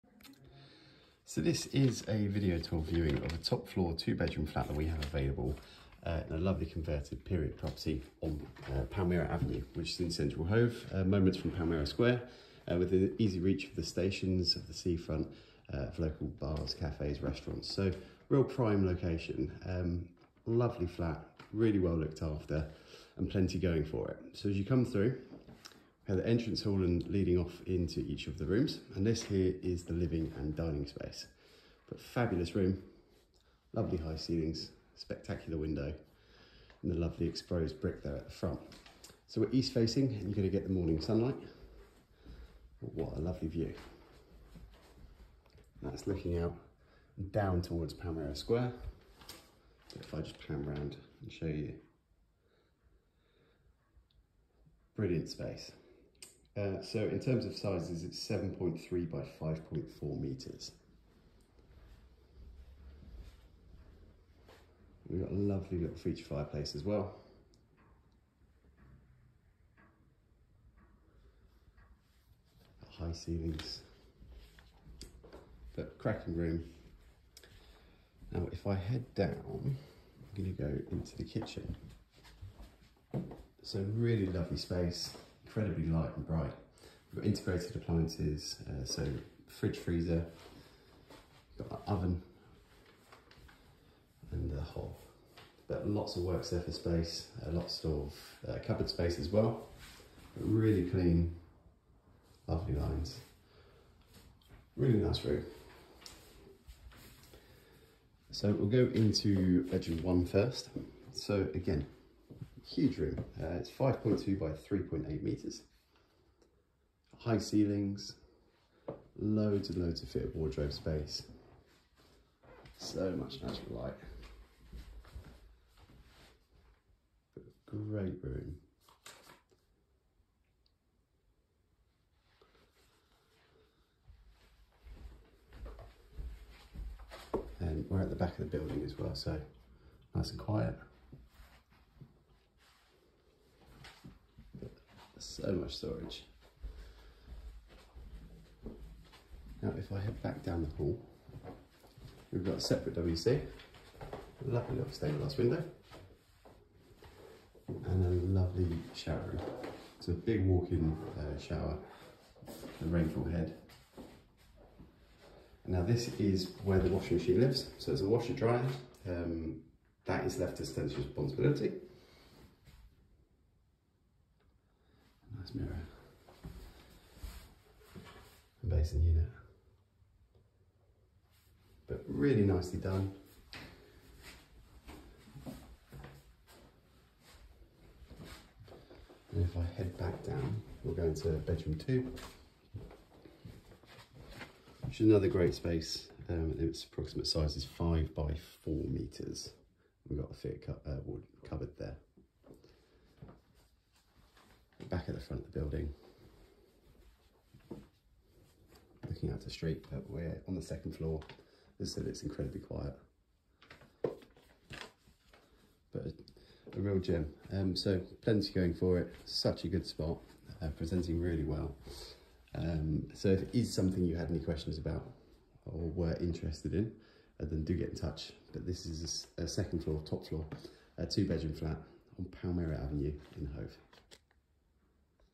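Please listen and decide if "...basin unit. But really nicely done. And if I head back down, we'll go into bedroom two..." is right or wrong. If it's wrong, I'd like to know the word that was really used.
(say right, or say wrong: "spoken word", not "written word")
right.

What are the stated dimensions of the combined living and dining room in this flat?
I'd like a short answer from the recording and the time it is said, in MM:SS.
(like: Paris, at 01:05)
7.3 by 5.4 meters, at 00:58.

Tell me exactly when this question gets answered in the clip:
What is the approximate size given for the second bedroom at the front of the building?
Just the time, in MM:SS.
03:17.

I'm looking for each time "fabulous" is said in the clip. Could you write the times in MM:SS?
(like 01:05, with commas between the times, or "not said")
00:32.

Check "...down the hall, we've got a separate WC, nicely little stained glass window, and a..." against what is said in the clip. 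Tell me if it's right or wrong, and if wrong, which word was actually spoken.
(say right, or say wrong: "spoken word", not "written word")
wrong: "lovely", not "nicely".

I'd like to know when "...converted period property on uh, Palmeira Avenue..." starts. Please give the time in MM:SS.
00:06.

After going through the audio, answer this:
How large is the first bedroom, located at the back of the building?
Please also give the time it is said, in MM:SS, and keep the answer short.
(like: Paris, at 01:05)
5.2 by 3.8 meters, at 01:53.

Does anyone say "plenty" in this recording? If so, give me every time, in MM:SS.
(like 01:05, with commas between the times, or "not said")
00:23, 03:38.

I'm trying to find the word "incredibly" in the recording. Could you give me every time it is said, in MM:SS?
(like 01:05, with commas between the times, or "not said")
01:25, 03:32.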